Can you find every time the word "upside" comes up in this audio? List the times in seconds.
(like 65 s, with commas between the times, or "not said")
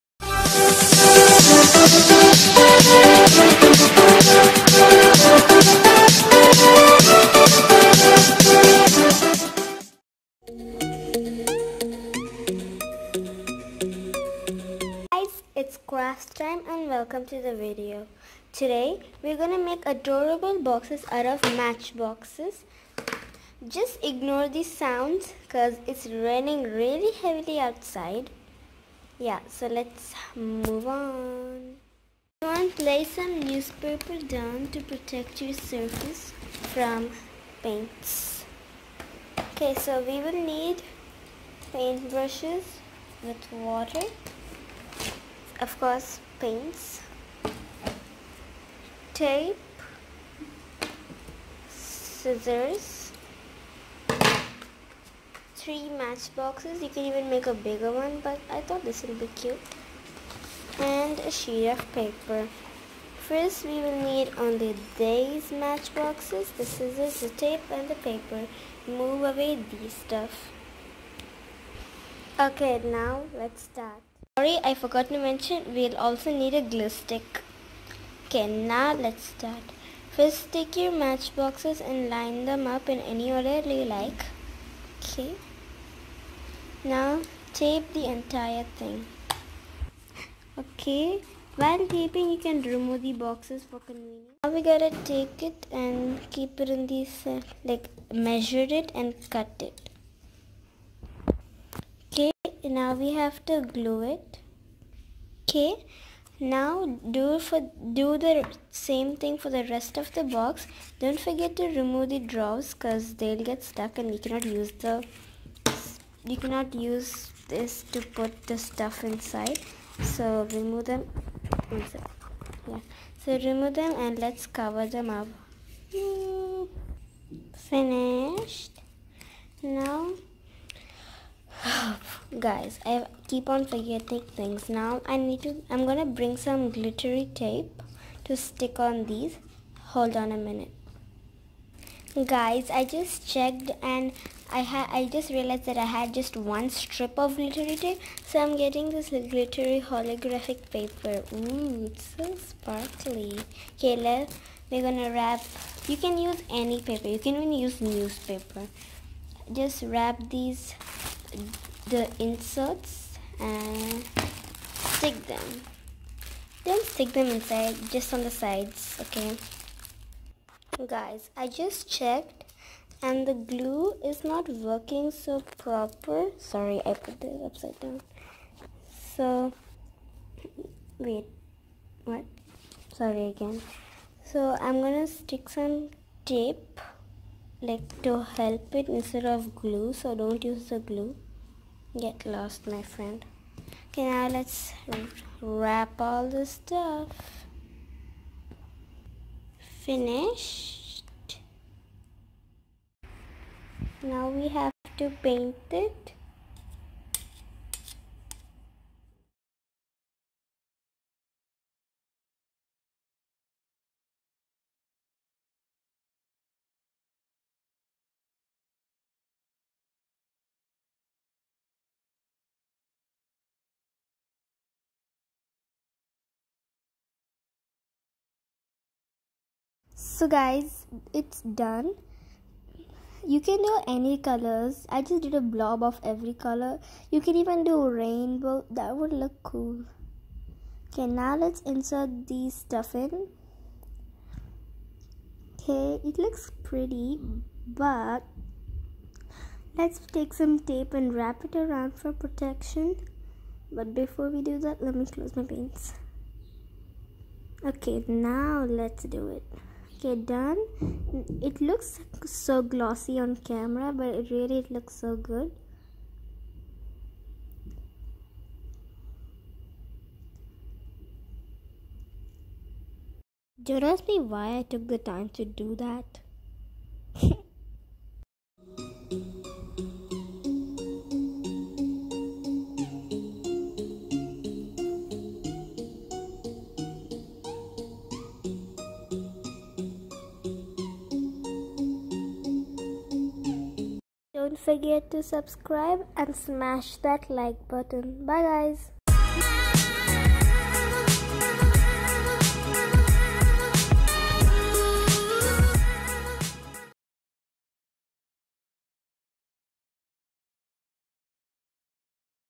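177 s.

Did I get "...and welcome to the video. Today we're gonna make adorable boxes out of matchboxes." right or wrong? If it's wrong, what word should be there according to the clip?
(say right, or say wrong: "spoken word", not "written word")
right.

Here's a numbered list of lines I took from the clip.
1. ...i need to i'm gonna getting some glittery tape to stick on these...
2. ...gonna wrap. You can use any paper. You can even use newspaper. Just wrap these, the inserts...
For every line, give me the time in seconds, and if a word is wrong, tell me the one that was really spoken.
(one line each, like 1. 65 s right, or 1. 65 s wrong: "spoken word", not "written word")
1. 135 s wrong: "bring", not "getting"
2. 154 s right.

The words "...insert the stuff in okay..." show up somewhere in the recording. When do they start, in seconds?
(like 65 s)
241 s.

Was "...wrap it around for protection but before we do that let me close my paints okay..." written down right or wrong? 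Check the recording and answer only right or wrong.
right.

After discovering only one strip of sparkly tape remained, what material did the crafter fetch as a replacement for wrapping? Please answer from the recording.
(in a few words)
Glittery holographic paper.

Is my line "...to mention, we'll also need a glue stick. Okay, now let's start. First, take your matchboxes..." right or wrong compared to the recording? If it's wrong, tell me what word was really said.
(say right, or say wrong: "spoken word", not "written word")
right.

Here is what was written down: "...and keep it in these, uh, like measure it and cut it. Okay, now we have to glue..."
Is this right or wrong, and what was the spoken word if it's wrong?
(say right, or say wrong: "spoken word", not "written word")
right.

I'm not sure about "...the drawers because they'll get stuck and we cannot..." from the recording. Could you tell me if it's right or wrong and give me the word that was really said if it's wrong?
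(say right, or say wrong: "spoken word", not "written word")
right.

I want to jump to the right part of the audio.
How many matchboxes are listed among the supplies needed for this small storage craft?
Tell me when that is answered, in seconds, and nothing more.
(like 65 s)
55 s.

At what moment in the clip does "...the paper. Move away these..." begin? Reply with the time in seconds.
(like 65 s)
67 s.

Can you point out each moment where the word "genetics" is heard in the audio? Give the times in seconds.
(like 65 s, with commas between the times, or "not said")
not said.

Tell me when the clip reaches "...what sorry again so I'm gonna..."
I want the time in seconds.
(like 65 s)
182 s.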